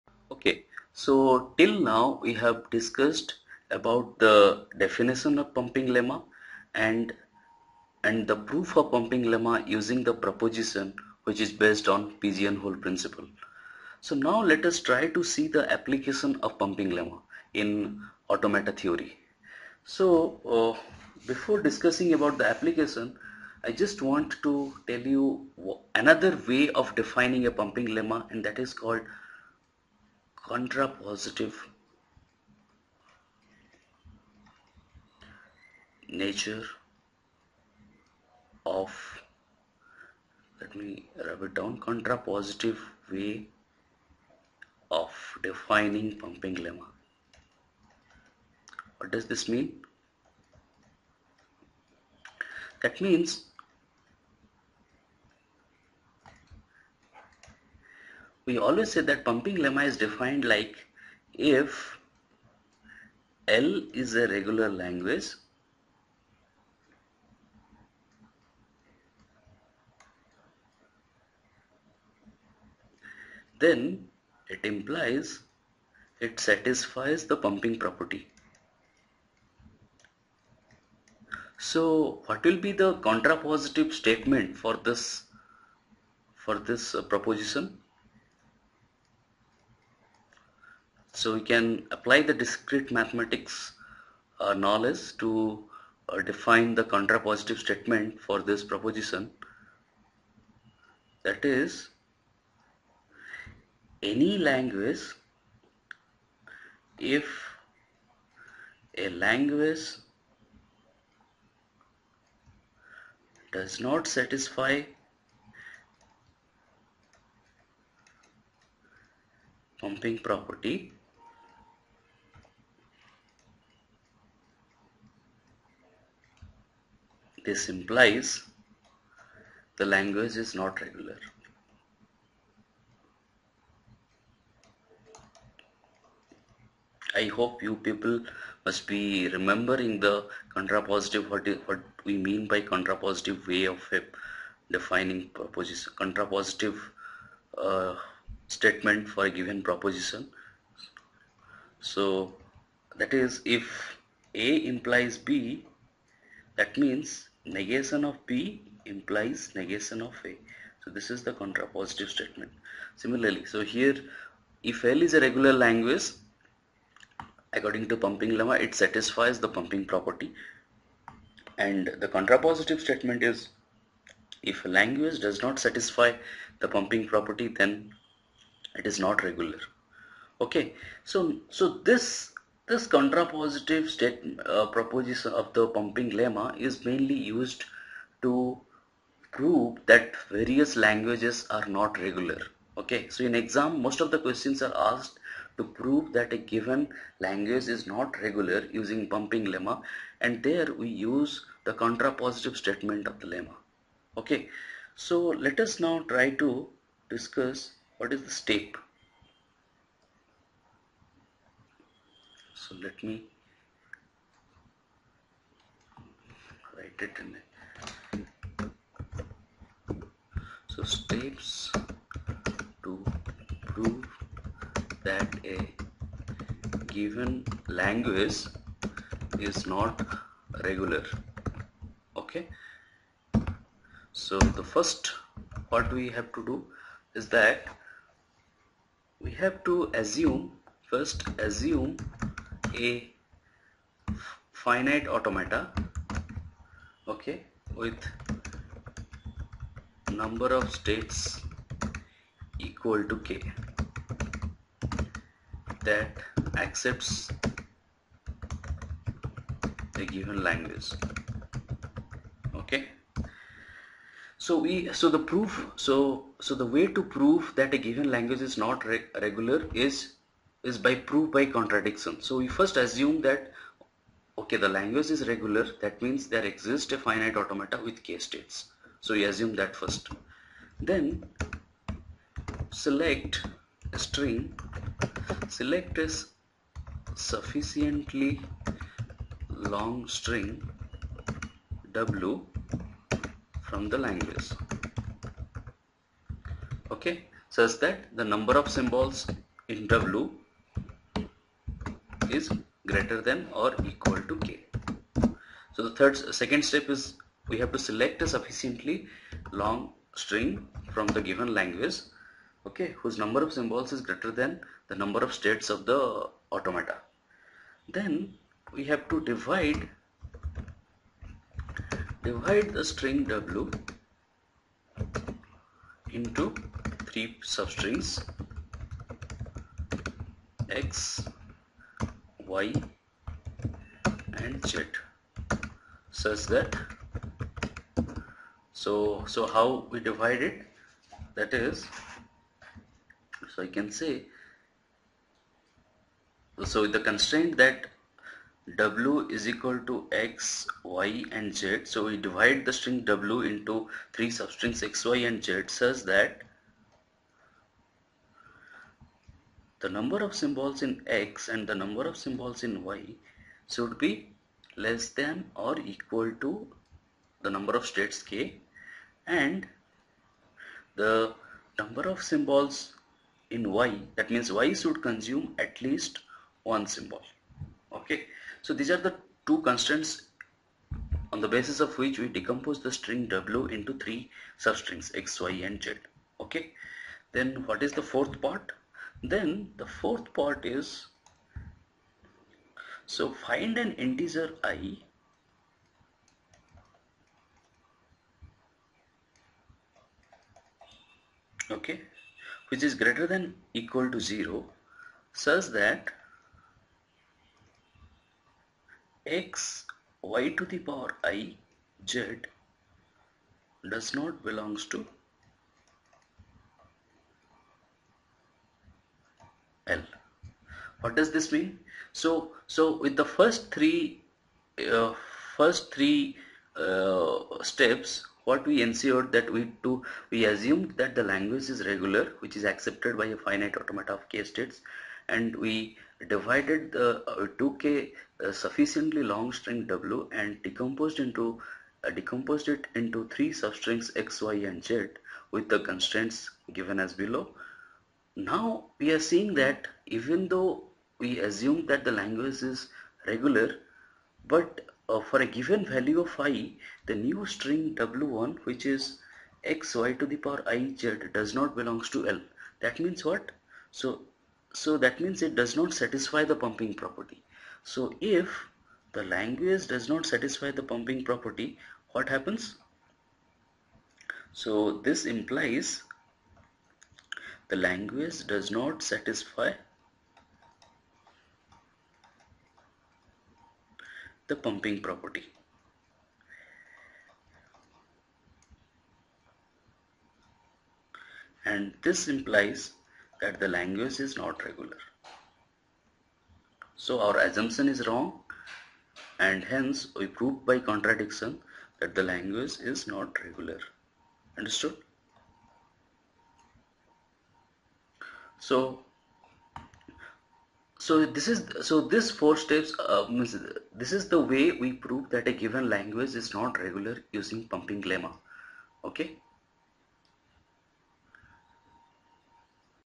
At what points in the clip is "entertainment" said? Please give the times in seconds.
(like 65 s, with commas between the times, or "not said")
not said.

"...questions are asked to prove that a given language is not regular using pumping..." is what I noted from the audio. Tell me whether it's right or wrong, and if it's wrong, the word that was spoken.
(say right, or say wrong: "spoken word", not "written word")
right.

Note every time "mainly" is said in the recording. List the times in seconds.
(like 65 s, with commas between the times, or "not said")
186 s.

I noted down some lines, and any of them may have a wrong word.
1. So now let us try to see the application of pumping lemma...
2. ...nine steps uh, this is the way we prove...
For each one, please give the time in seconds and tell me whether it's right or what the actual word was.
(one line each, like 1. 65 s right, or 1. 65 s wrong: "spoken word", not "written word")
1. 14 s right
2. 512 s wrong: "four", not "nine".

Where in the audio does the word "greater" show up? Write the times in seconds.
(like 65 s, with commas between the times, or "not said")
302 s, 314 s, 402 s.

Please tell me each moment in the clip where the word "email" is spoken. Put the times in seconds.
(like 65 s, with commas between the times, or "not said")
not said.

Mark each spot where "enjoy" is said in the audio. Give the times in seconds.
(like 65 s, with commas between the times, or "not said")
not said.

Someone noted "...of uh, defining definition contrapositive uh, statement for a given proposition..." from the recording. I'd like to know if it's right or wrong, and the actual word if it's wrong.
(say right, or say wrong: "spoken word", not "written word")
wrong: "proposition", not "definition".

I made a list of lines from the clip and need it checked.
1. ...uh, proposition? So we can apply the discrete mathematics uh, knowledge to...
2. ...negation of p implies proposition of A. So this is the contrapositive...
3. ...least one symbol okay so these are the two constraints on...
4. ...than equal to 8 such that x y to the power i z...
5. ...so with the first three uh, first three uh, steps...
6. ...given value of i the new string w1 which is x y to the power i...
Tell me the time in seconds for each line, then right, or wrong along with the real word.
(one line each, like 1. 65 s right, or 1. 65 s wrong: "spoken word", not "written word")
1. 86 s right
2. 157 s wrong: "negation", not "proposition"
3. 375 s right
4. 403 s wrong: "0", not "8"
5. 422 s right
6. 455 s right.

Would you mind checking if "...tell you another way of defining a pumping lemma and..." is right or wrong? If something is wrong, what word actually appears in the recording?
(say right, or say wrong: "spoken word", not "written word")
right.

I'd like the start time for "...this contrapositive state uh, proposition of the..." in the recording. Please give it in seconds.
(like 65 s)
182 s.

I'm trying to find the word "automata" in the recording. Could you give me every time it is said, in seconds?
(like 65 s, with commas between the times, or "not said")
18 s, 245 s, 277 s, 316 s, 433 s.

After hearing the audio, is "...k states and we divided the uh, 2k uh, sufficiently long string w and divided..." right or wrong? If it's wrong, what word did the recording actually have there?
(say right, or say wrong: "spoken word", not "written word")
wrong: "decomposed", not "divided".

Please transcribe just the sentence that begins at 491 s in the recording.
And this implies that the language is not regular.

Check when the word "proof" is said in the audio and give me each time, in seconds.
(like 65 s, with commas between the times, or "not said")
8 s, 265 s, 270 s.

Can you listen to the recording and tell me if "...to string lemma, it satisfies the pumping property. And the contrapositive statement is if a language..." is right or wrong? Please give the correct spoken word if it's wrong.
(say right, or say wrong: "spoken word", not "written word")
wrong: "pumping", not "string".